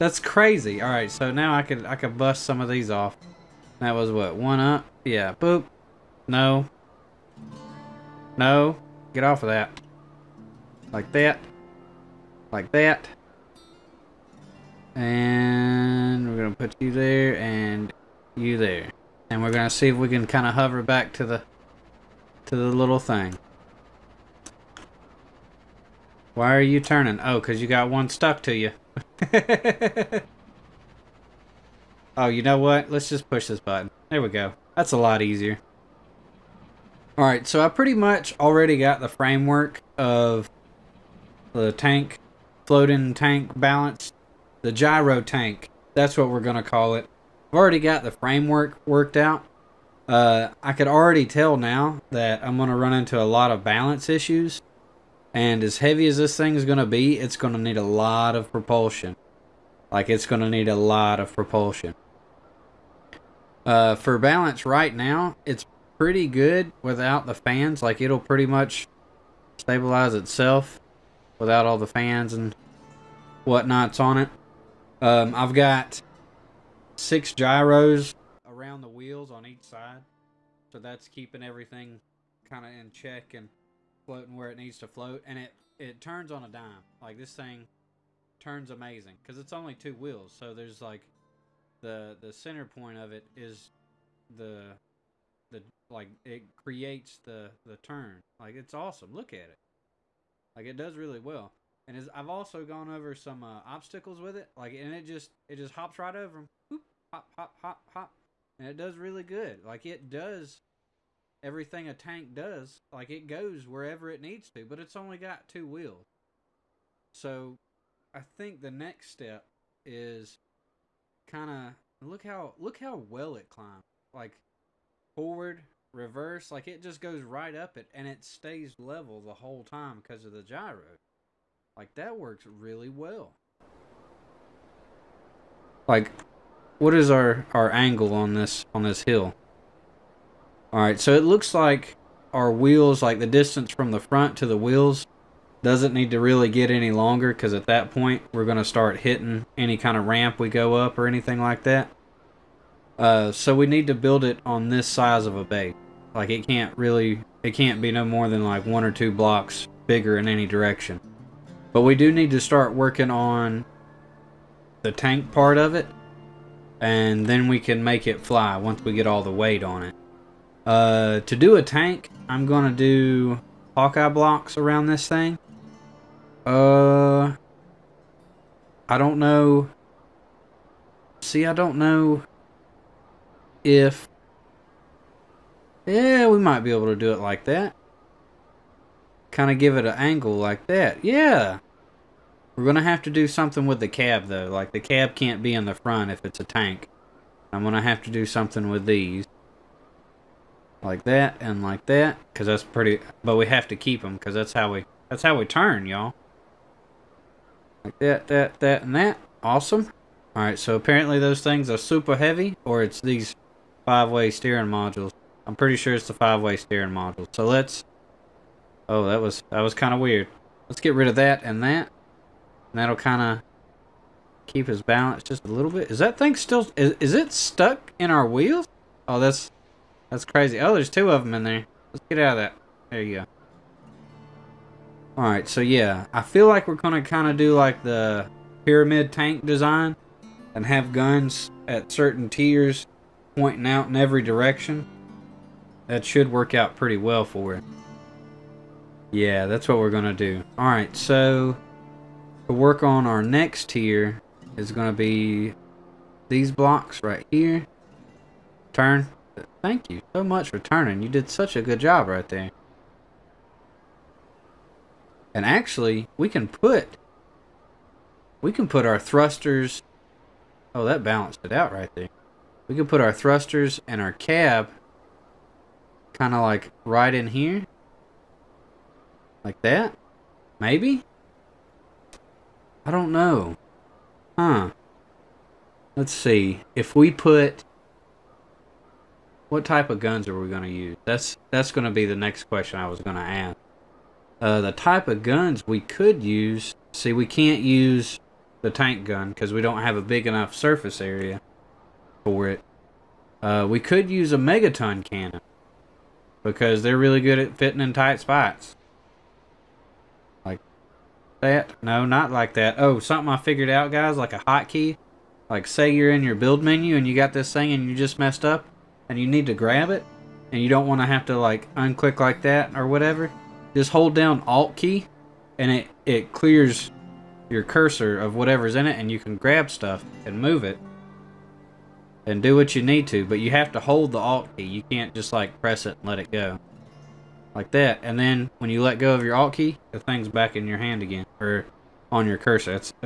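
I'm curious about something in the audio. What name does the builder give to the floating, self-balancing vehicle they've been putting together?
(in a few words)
the gyro tank.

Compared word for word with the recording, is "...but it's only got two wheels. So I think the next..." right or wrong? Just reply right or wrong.
right.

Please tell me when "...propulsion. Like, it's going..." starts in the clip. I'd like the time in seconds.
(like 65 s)
58 s.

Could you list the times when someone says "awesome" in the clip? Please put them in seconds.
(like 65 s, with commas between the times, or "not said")
98 s, 209 s.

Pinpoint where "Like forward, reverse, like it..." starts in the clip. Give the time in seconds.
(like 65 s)
124 s.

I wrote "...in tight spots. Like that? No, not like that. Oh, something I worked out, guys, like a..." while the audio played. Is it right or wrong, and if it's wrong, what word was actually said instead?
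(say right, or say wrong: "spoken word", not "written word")
wrong: "figured", not "worked".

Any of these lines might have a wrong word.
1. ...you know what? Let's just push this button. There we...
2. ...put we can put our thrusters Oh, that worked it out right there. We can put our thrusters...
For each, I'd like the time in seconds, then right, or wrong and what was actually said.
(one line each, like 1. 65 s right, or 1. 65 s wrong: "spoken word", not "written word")
1. 32 s right
2. 266 s wrong: "balanced", not "worked".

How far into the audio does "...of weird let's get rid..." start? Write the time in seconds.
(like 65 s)
219 s.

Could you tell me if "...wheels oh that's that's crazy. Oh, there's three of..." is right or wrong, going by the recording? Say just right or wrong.
wrong.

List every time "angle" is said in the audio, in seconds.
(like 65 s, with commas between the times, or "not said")
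137 s, 189 s.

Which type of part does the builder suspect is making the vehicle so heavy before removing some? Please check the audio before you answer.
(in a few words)
five-way steering modules.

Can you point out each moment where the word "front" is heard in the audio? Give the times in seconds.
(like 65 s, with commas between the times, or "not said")
143 s, 195 s.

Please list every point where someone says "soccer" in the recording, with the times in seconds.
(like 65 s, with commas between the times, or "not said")
not said.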